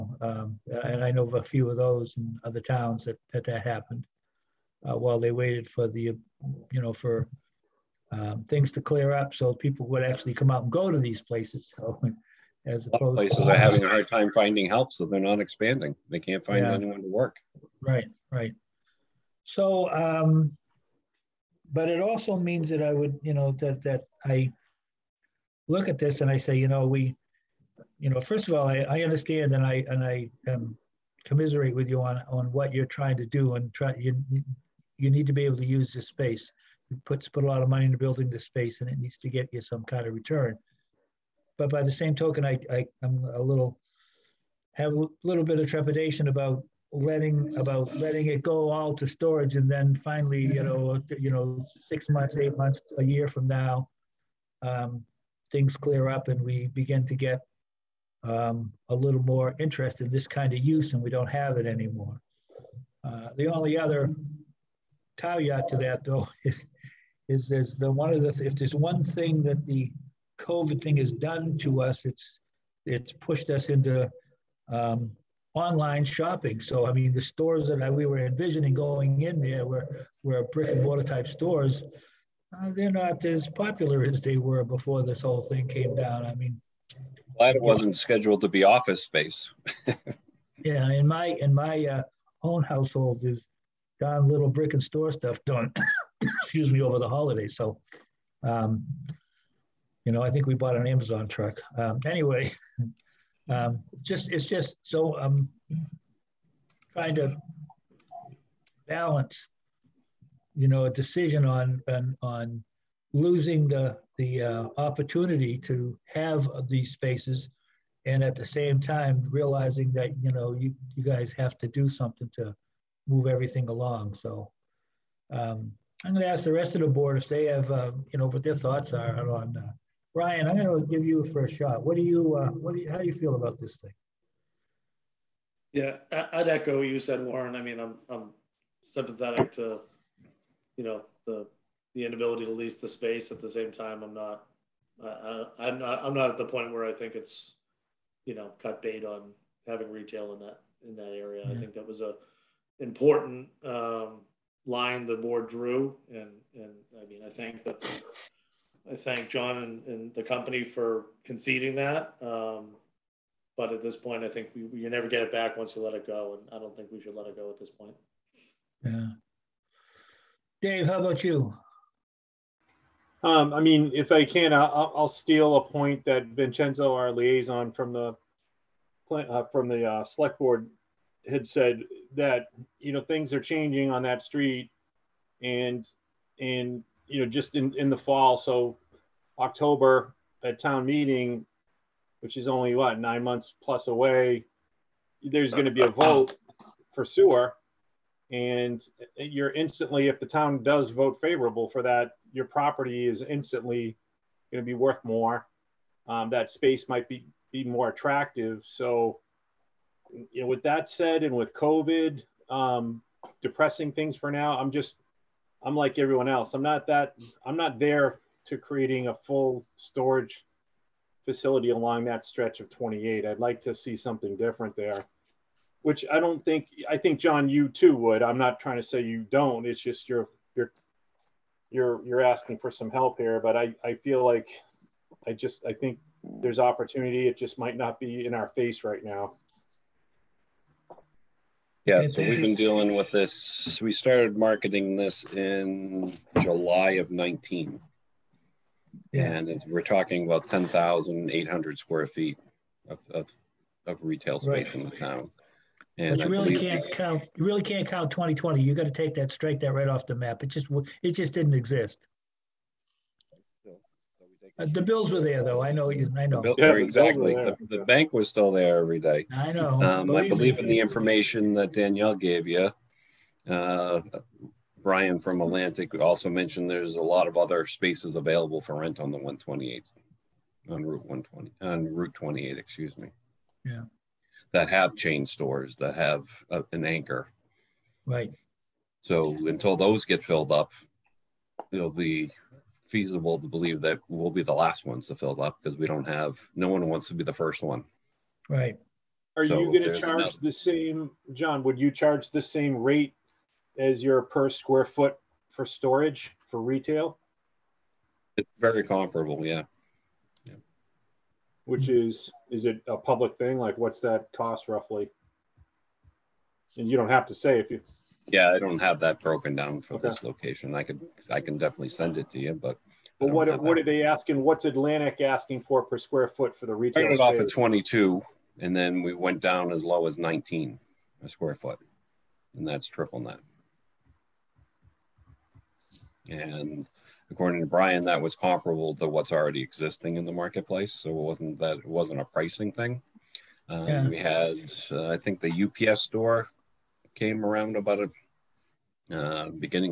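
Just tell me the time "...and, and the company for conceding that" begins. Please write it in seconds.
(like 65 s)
159 s.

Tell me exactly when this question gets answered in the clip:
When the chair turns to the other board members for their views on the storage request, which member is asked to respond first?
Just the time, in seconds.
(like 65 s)
130 s.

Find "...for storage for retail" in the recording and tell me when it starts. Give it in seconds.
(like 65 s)
305 s.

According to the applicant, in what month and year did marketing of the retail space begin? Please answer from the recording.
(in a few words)
July 2019.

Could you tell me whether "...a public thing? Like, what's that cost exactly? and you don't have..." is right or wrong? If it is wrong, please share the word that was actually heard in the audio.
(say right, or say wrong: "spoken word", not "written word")
wrong: "roughly", not "exactly".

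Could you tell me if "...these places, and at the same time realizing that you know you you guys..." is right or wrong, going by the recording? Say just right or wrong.
wrong.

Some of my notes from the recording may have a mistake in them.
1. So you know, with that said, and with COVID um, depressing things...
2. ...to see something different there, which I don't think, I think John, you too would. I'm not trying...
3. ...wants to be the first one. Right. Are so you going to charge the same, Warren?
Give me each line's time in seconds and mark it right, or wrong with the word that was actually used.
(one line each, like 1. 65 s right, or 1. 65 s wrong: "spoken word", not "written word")
1. 208 s right
2. 223 s right
3. 296 s wrong: "John", not "Warren".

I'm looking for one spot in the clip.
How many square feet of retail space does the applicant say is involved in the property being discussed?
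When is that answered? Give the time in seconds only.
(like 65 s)
250 s.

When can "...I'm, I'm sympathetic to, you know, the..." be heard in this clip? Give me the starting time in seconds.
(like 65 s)
137 s.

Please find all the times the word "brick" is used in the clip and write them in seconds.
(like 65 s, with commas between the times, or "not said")
80 s, 94 s.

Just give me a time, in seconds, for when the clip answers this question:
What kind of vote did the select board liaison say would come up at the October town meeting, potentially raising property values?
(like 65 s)
197 s.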